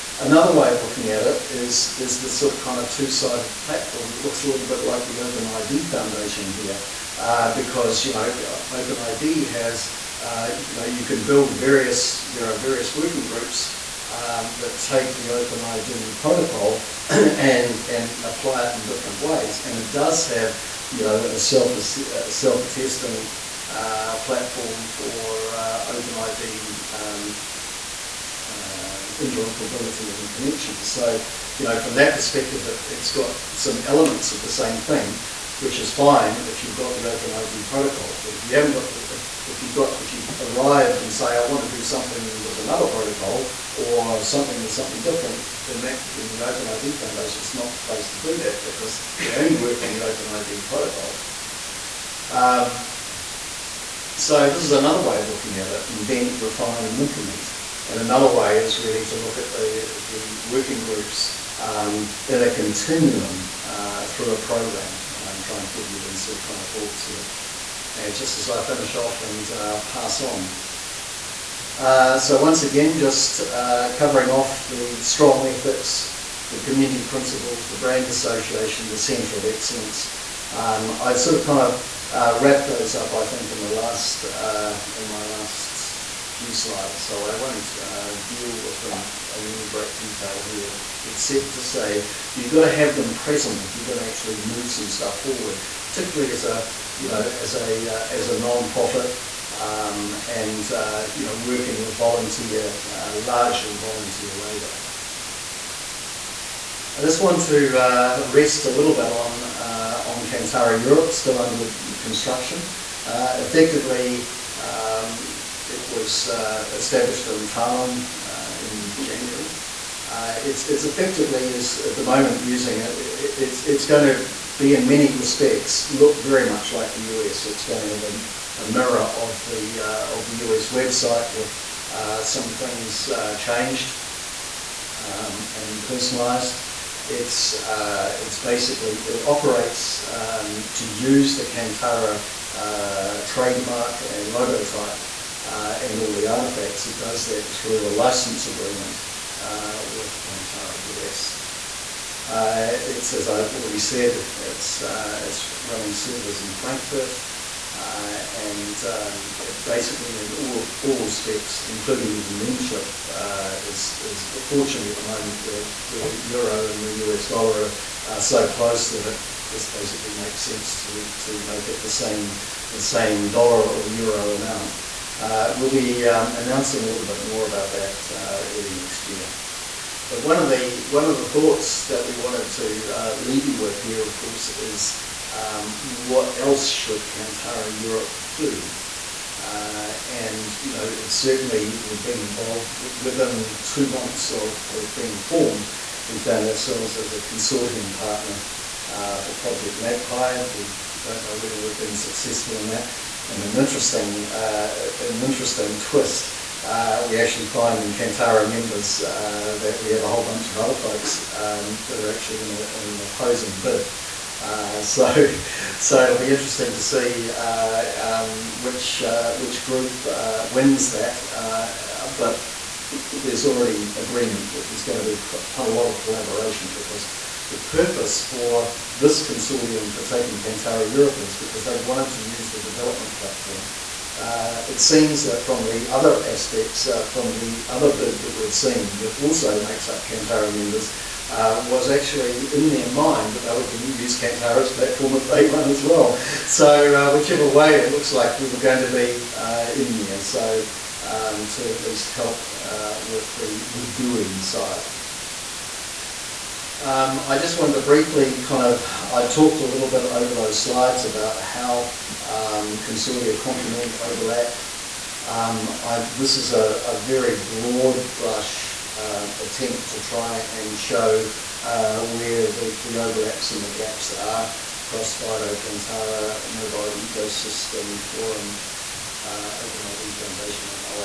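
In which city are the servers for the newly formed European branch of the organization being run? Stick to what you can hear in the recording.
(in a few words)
Frankfurt.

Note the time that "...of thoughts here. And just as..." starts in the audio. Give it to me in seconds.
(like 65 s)
66 s.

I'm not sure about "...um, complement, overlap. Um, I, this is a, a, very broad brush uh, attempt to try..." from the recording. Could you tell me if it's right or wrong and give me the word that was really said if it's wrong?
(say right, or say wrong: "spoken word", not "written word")
right.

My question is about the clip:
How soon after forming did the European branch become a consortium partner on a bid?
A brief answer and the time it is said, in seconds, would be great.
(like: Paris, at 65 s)
2 months, at 193 s.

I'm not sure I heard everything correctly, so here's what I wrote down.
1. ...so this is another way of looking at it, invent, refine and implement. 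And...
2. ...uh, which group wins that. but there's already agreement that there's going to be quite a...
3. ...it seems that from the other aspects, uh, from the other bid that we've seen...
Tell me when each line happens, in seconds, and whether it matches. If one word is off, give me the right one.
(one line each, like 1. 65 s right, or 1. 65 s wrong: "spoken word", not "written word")
1. 54 s right
2. 219 s right
3. 234 s right.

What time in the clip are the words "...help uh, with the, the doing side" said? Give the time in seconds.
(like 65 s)
252 s.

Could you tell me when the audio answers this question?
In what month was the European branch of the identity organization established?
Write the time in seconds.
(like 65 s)
119 s.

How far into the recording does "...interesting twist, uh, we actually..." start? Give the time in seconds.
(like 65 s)
205 s.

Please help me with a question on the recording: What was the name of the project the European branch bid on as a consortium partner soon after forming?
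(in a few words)
Project Magpie.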